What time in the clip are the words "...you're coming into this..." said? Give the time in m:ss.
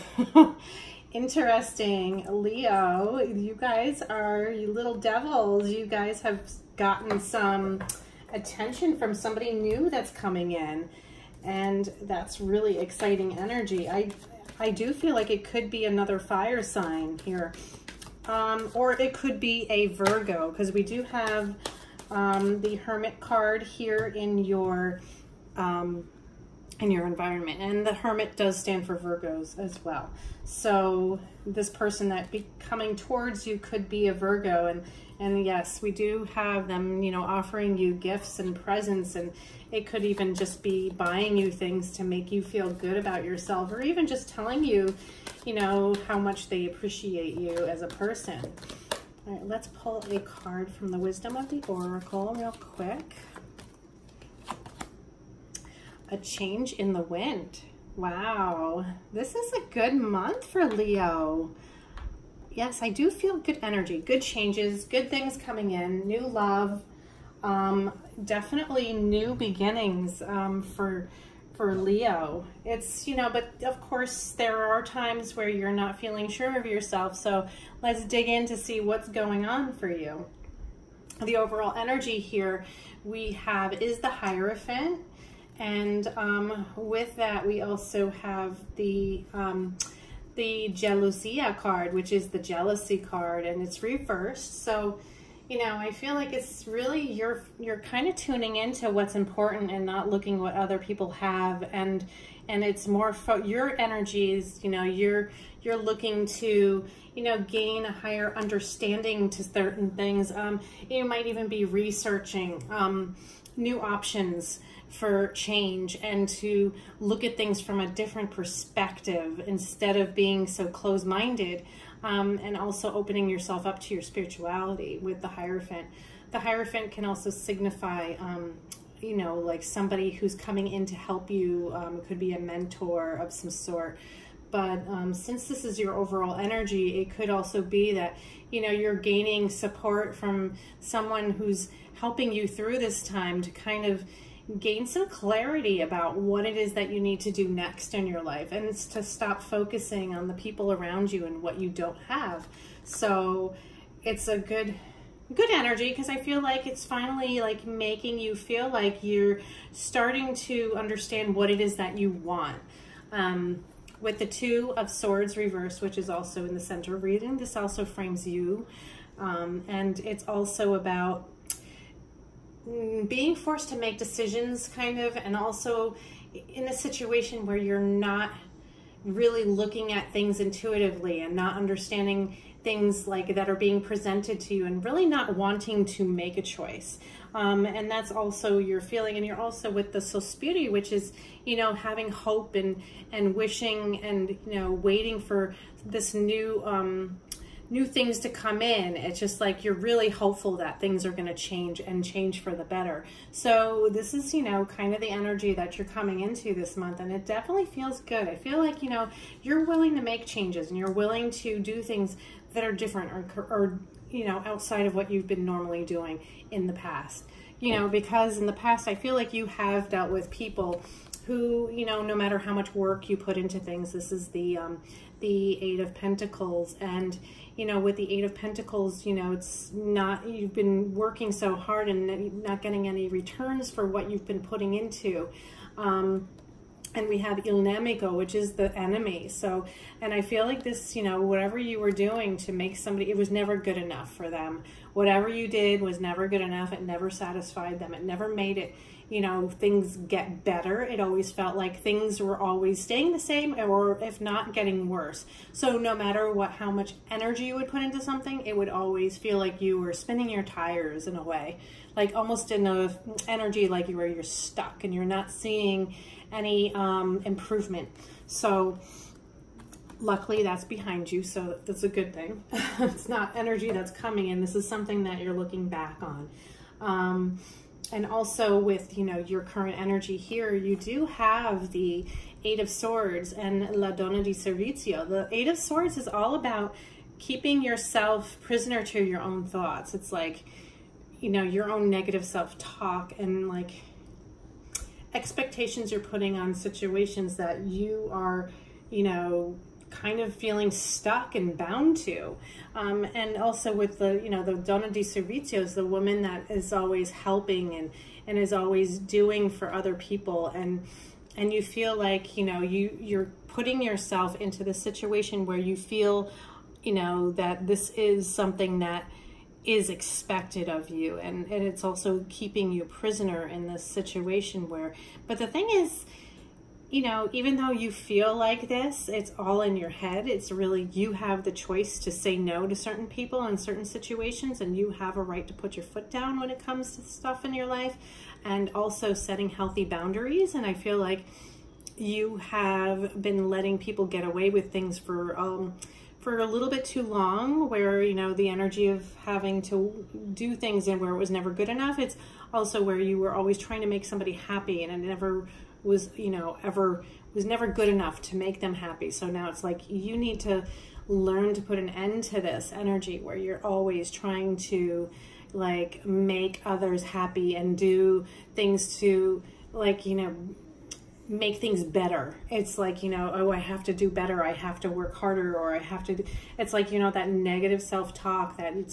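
3:25.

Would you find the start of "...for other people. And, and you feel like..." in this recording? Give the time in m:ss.
5:09.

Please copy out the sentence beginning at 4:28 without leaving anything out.
So, luckily that's behind you, so that's a good thing.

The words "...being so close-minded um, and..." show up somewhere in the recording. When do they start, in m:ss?
2:00.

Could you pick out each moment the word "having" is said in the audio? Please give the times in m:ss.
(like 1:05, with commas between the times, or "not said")
3:11, 5:49.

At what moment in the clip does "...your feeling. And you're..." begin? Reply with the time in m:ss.
3:08.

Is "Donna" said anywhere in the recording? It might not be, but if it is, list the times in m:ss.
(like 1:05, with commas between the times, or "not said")
4:43, 5:04.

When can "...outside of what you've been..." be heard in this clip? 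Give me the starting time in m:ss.
3:34.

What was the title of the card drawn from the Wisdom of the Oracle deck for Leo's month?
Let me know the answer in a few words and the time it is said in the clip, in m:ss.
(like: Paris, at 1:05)
A change in the wind, at 0:56.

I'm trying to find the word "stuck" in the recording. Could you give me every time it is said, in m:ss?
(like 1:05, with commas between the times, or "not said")
4:24, 5:00.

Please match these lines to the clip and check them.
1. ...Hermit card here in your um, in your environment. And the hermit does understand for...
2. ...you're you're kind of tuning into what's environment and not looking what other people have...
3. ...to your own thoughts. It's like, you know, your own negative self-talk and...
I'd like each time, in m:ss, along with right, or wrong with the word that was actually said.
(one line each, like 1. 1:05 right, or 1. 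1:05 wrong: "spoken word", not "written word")
1. 0:22 wrong: "stand", not "understand"
2. 1:37 wrong: "important", not "environment"
3. 4:48 right.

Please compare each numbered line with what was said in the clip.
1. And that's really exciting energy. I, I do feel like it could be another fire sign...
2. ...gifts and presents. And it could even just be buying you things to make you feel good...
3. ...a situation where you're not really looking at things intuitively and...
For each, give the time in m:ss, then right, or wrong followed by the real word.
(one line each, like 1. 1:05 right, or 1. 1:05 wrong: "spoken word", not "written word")
1. 0:11 right
2. 0:37 right
3. 2:56 right.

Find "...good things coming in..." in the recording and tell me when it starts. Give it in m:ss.
1:04.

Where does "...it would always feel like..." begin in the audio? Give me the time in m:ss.
4:18.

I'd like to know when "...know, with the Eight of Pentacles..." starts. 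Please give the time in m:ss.
3:47.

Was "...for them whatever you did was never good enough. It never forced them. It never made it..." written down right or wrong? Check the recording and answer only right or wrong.
wrong.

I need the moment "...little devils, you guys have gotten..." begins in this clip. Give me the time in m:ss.
0:04.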